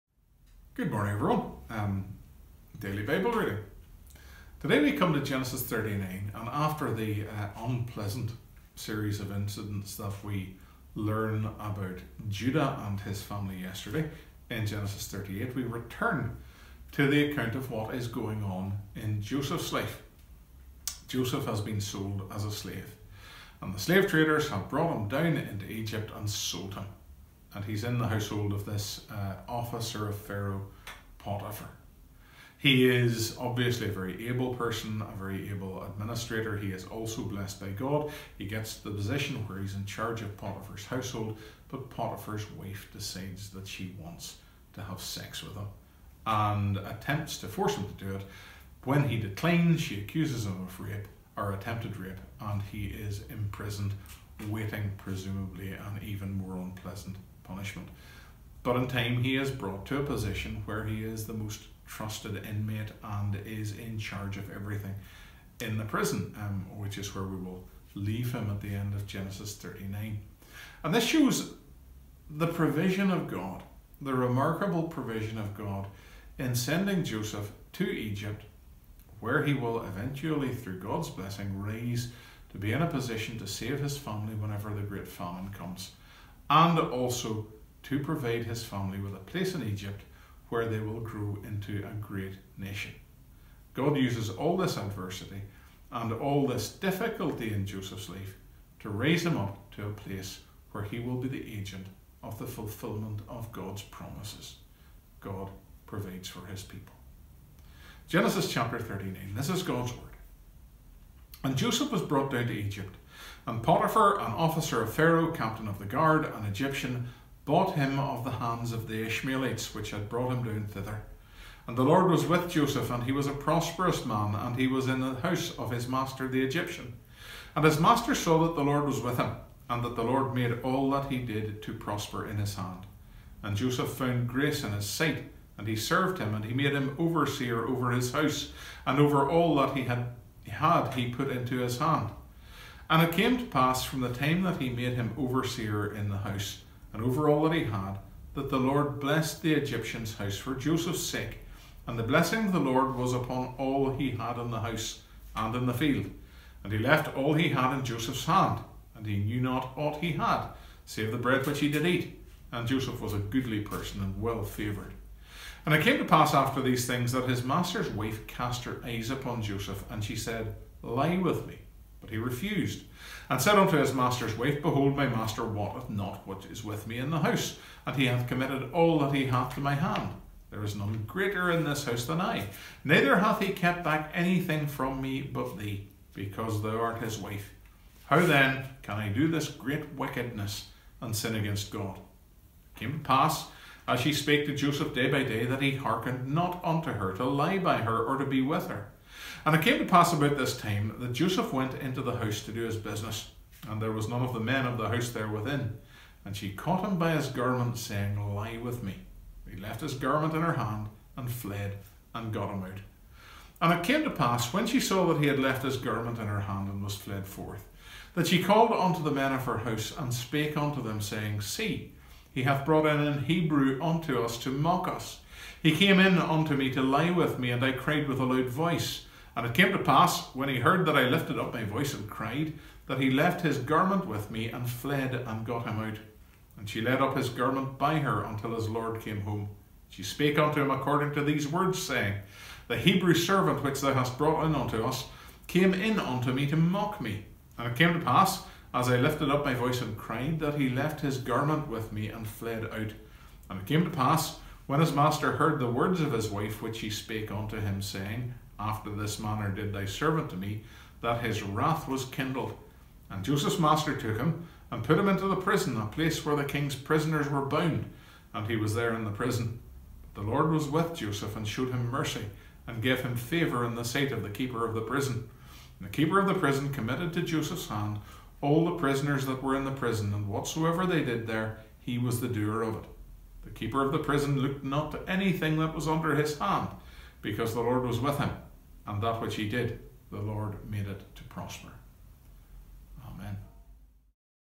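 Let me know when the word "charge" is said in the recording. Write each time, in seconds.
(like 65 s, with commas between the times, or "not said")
39 s, 63 s.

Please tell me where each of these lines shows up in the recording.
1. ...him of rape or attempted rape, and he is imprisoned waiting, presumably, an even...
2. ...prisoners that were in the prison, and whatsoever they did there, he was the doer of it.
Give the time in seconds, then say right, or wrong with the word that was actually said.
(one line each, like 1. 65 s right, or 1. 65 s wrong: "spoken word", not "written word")
1. 50 s right
2. 278 s right.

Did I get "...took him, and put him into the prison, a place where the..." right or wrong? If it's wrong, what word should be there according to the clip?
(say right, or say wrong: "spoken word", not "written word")
right.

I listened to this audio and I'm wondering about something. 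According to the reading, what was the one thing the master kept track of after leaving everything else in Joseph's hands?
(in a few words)
the bread which he did eat.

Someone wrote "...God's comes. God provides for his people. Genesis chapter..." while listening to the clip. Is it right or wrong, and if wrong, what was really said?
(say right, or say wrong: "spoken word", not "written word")
wrong: "promises", not "comes".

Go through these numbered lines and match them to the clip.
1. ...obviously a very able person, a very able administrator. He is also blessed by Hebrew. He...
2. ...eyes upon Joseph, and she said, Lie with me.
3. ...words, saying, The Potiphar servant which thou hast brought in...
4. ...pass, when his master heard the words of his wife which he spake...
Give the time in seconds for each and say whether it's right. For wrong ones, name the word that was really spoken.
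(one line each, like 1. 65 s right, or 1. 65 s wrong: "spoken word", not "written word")
1. 33 s wrong: "God", not "Hebrew"
2. 168 s right
3. 241 s wrong: "Hebrew", not "Potiphar"
4. 253 s right.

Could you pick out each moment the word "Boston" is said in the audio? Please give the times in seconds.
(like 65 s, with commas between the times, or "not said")
not said.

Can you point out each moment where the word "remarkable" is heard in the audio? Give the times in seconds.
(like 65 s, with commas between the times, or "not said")
74 s.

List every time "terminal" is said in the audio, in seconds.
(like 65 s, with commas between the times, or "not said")
not said.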